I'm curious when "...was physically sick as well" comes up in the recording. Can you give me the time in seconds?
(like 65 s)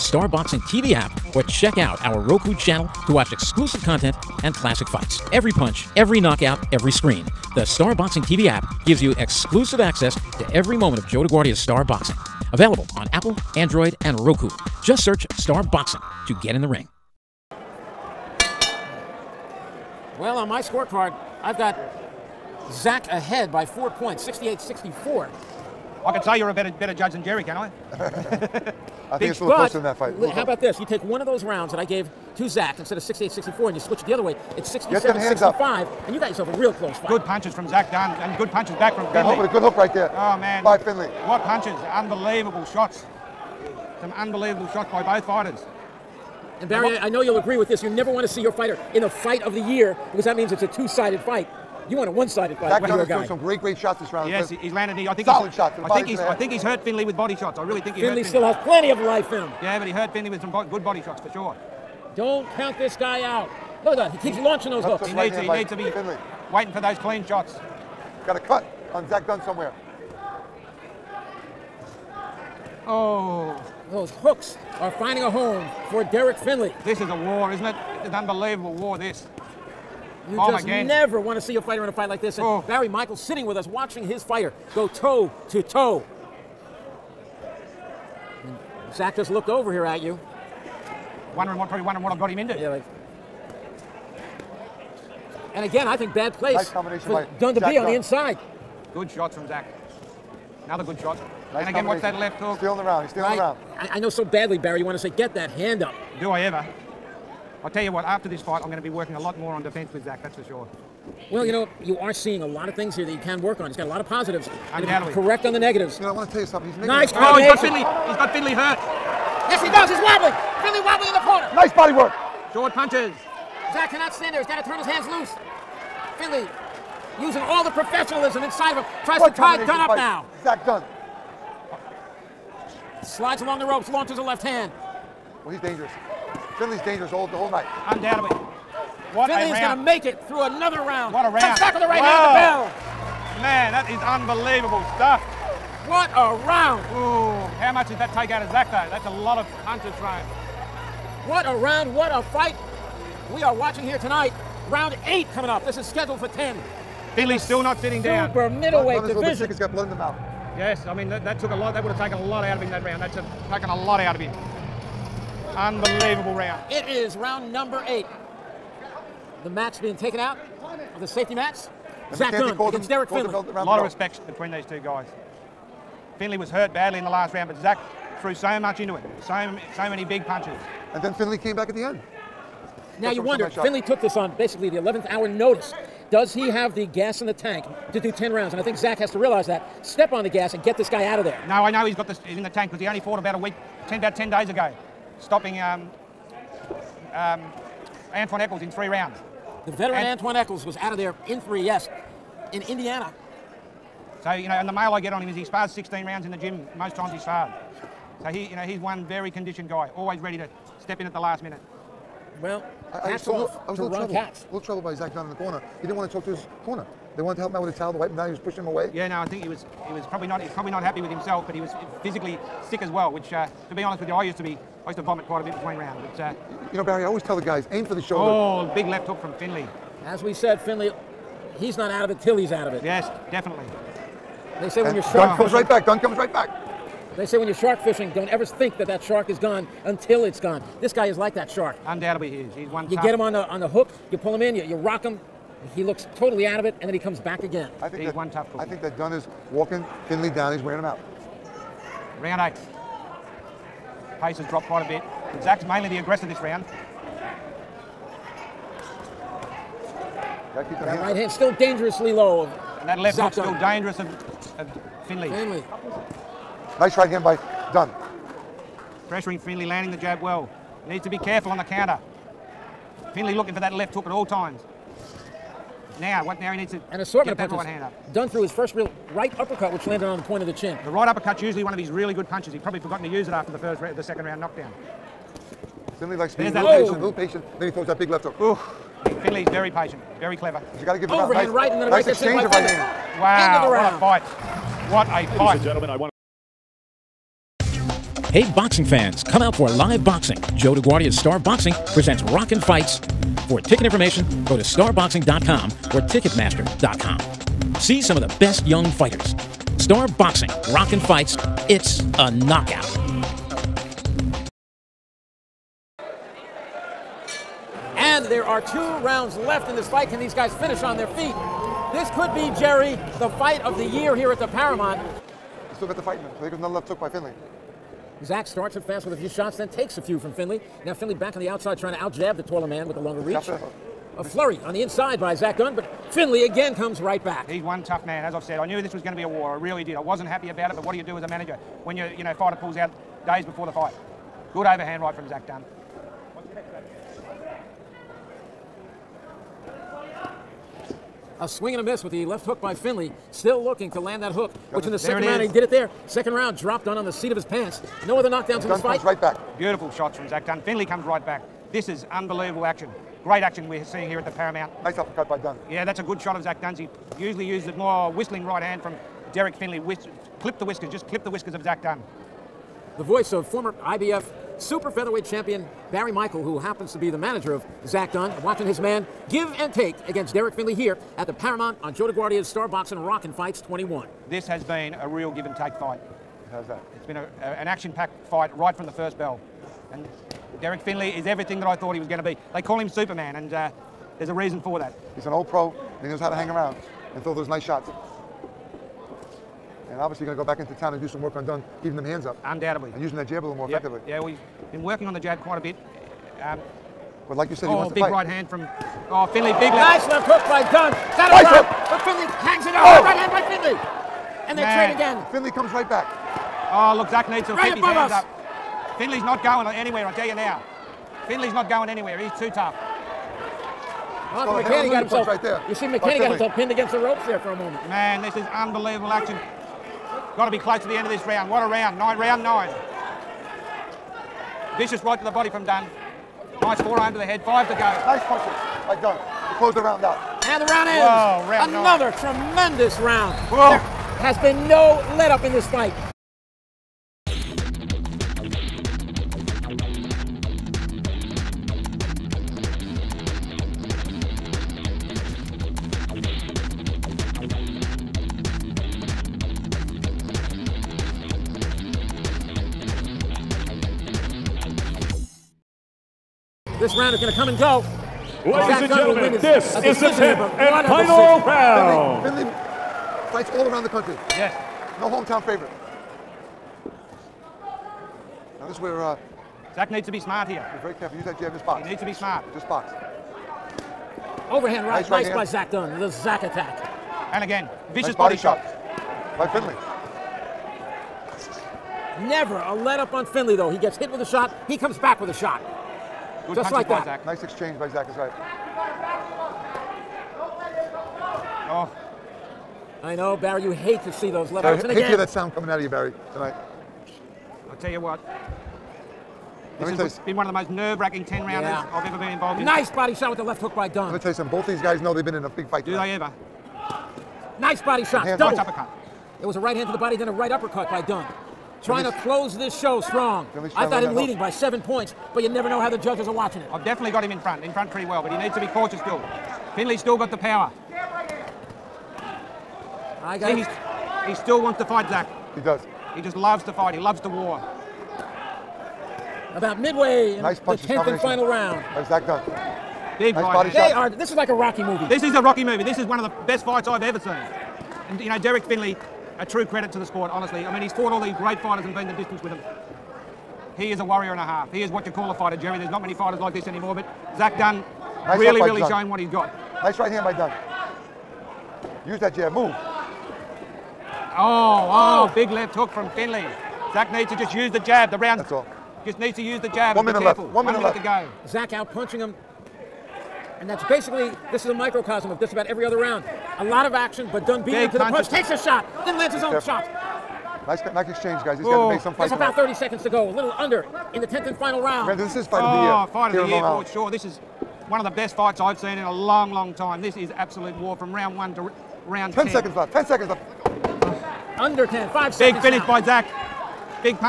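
221 s.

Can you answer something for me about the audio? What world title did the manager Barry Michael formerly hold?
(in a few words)
IBF super featherweight.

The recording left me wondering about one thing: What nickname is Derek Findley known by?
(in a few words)
Superman.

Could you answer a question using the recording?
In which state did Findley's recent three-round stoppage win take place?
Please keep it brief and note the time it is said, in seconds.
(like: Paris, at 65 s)
Indiana, at 202 s.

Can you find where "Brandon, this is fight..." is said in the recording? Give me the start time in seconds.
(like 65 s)
585 s.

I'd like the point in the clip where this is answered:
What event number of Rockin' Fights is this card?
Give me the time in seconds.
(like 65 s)
383 s.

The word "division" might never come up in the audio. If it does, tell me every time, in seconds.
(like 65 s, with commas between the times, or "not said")
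159 s.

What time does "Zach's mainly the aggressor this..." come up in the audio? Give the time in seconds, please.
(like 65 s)
255 s.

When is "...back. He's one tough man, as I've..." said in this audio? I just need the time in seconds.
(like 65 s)
337 s.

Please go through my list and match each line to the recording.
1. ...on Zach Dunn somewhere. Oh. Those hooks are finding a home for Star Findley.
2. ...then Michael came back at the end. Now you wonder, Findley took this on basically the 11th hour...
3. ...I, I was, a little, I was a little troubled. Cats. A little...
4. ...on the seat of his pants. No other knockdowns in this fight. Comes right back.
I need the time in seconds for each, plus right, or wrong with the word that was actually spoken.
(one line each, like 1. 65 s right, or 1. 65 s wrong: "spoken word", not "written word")
1. 68 s wrong: "Derek", not "Star"
2. 181 s wrong: "Findley", not "Michael"
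3. 212 s right
4. 356 s right.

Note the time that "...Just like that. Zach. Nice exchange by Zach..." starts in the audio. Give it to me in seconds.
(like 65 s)
496 s.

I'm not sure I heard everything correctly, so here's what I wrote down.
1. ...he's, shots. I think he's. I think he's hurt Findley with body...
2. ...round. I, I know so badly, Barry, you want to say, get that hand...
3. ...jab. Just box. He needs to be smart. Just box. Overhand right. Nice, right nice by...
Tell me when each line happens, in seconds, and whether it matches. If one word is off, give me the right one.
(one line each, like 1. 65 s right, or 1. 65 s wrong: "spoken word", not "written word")
1. 55 s right
2. 103 s right
3. 481 s right.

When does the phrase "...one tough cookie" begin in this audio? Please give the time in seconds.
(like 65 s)
248 s.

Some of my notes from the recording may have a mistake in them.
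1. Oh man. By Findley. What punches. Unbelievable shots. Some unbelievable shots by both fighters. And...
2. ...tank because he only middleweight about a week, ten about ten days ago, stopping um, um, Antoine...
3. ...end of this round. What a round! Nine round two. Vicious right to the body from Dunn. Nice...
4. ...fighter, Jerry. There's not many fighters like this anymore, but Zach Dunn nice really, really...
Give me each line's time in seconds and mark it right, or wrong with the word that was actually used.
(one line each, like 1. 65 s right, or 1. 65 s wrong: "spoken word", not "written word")
1. 40 s right
2. 192 s wrong: "fought", not "middleweight"
3. 430 s wrong: "nine", not "two"
4. 555 s right.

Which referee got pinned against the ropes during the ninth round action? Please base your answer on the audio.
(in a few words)
Arthur Mercante.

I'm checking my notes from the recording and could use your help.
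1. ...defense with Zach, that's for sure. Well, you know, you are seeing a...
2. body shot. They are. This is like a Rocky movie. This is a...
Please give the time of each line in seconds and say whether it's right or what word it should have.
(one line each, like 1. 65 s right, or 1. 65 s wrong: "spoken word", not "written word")
1. 109 s right
2. 543 s right.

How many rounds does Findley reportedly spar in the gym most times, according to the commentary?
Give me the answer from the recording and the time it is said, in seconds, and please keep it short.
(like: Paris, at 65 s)
16, at 205 s.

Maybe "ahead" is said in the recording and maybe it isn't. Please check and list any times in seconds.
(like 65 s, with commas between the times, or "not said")
23 s.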